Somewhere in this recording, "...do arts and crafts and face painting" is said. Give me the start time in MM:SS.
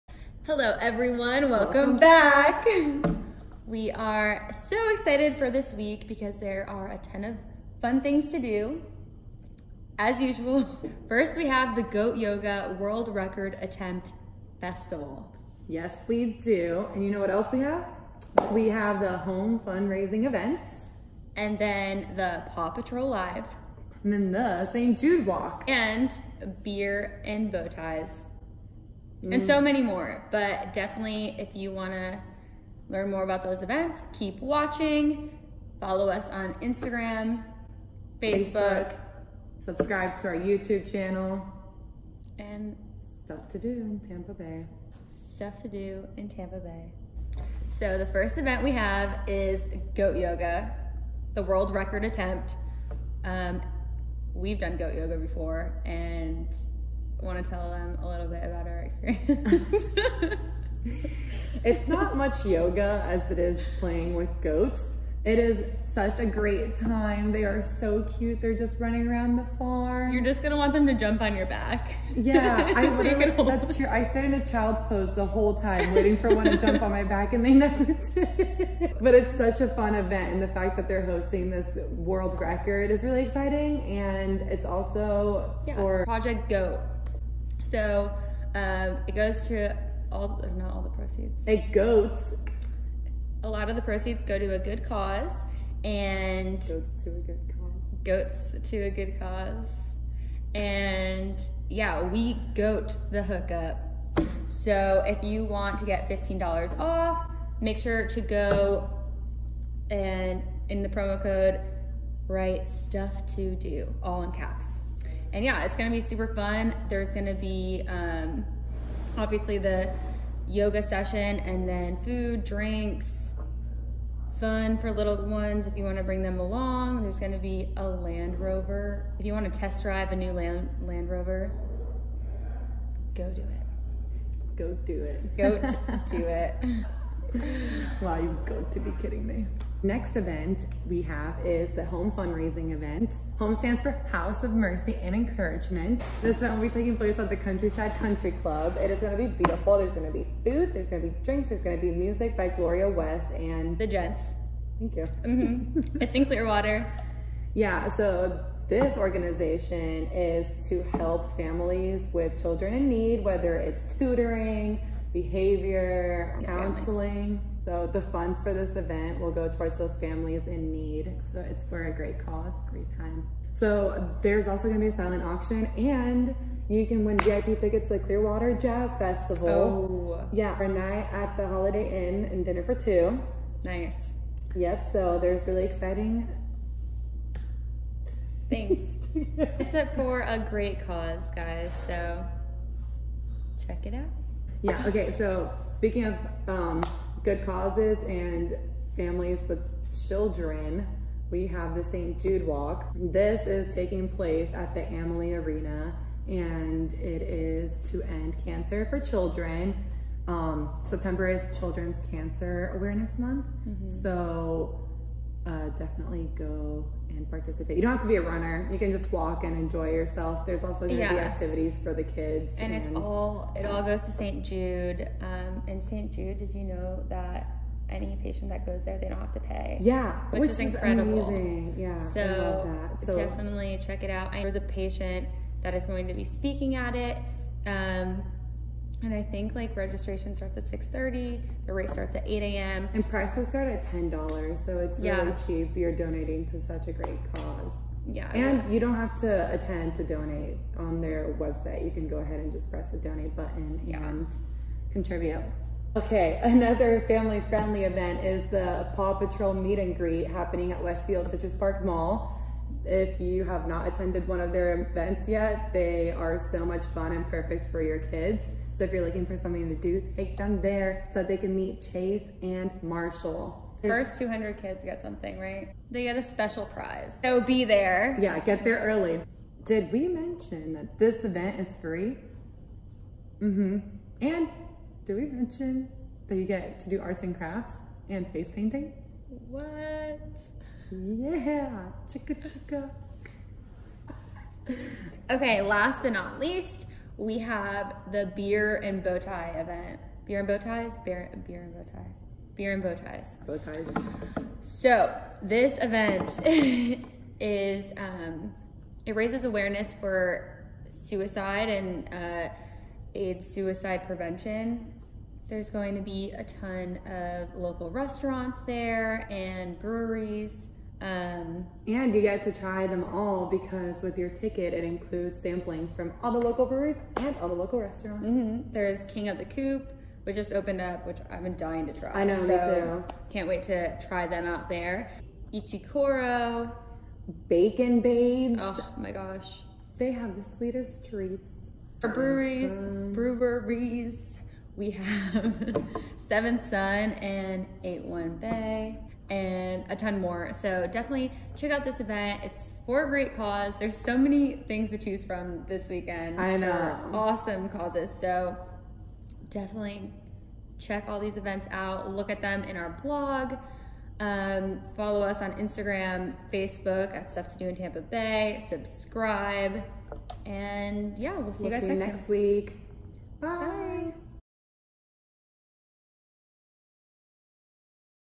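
04:46.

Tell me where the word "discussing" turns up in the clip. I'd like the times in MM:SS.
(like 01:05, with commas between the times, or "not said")
not said.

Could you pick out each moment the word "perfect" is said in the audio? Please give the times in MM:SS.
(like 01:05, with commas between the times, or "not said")
04:27.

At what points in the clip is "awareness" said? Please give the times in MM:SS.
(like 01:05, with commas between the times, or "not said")
03:32, 05:09.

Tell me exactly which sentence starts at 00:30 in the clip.
But definitely, if you want to learn more about those events, keep watching.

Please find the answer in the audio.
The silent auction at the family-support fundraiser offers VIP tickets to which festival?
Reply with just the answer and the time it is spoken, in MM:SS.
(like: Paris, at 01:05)
Clearwater Jazz Festival, at 02:57.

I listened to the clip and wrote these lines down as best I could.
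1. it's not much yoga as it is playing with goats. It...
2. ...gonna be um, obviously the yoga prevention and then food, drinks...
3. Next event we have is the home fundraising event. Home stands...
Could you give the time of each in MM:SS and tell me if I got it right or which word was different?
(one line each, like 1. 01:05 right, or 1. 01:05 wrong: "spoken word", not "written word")
1. 01:01 right
2. 01:57 wrong: "session", not "prevention"
3. 02:19 right.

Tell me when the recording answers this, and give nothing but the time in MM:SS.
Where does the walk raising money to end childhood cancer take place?
03:24.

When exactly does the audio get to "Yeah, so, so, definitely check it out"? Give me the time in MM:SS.
03:51.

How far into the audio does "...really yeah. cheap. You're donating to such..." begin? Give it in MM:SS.
04:04.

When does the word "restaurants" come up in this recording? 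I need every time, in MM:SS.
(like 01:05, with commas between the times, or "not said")
05:17, 05:27.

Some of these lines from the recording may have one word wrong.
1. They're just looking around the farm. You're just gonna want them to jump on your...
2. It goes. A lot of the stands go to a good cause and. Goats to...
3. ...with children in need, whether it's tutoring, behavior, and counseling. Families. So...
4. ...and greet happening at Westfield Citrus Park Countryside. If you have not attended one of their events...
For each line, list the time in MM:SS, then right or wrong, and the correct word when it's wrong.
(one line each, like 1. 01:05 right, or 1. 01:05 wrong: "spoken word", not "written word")
1. 01:08 wrong: "running", not "looking"
2. 01:31 wrong: "proceeds", not "stands"
3. 02:42 right
4. 04:19 wrong: "Mall", not "Countryside".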